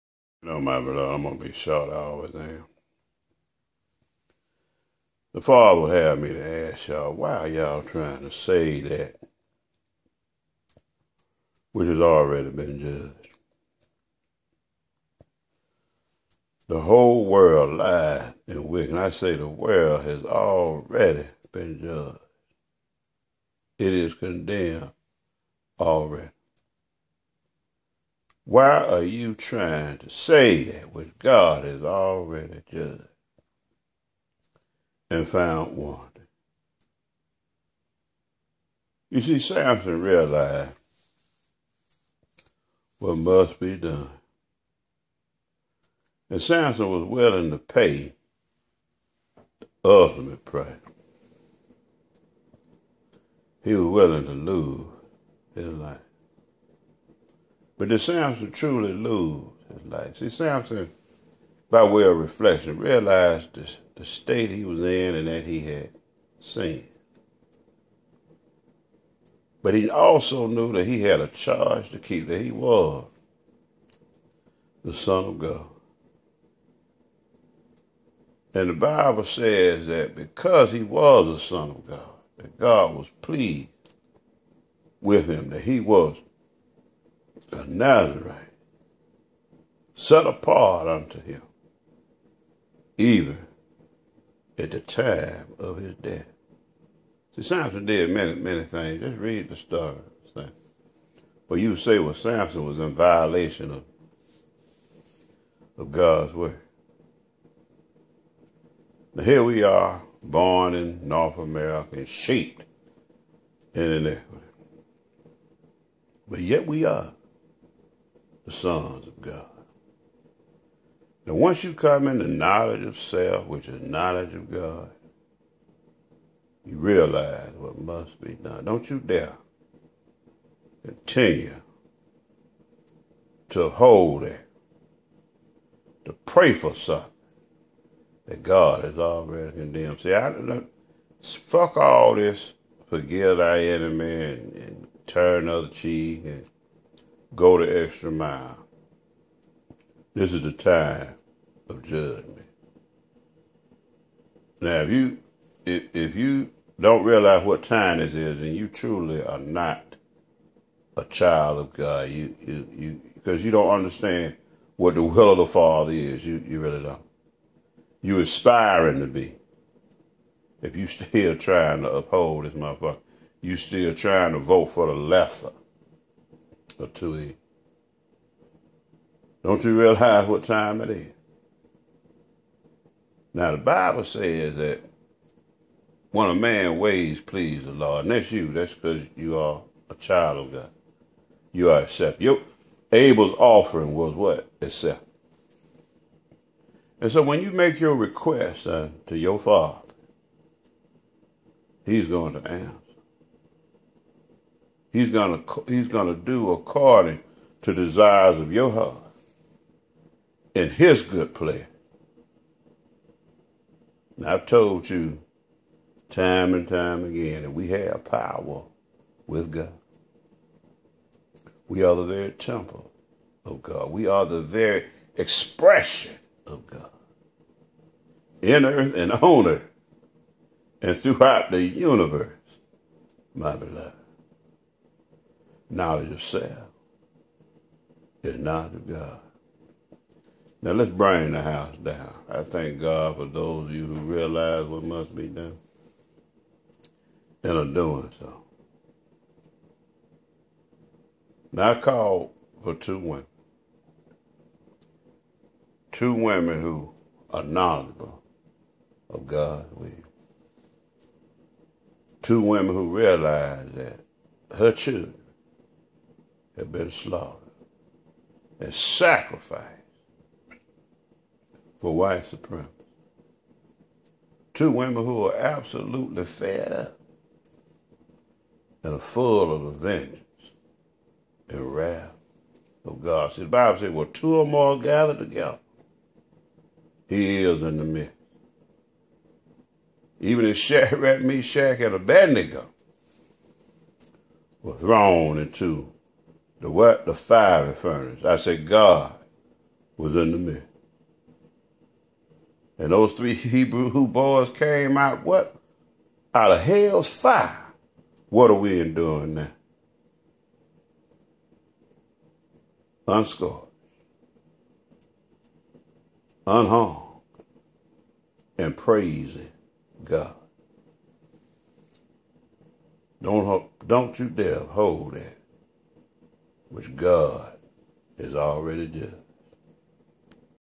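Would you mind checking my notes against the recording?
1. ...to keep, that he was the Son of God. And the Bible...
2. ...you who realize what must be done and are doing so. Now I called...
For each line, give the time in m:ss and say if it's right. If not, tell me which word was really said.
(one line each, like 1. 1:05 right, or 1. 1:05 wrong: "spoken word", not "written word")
1. 1:11 right
2. 4:03 right.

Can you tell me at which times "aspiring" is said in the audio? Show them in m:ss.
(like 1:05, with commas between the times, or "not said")
2:48.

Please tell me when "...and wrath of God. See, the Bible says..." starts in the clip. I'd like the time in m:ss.
4:41.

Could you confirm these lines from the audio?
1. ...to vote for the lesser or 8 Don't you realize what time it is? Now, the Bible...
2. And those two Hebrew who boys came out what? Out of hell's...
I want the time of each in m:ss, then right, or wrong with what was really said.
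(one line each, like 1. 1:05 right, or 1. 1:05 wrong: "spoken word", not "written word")
1. 2:54 wrong: "2", not "8"
2. 5:02 wrong: "three", not "two".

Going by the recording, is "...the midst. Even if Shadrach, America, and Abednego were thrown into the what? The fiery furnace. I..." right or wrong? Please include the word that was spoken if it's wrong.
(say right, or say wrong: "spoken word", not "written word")
wrong: "Meshach", not "America".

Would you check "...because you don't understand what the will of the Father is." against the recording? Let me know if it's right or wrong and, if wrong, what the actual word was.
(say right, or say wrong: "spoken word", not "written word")
right.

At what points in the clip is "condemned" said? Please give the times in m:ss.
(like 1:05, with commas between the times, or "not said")
0:24, 2:19.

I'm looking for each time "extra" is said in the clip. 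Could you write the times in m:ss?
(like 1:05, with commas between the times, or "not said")
2:27.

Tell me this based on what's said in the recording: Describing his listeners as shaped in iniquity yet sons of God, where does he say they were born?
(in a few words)
North America.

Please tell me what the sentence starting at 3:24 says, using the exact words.
He's gonna he's gonna do according to desires of your heart in his good pleasure.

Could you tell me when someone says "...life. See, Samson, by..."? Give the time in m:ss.
0:59.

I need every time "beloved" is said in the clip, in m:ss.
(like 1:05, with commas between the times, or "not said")
0:00, 3:53.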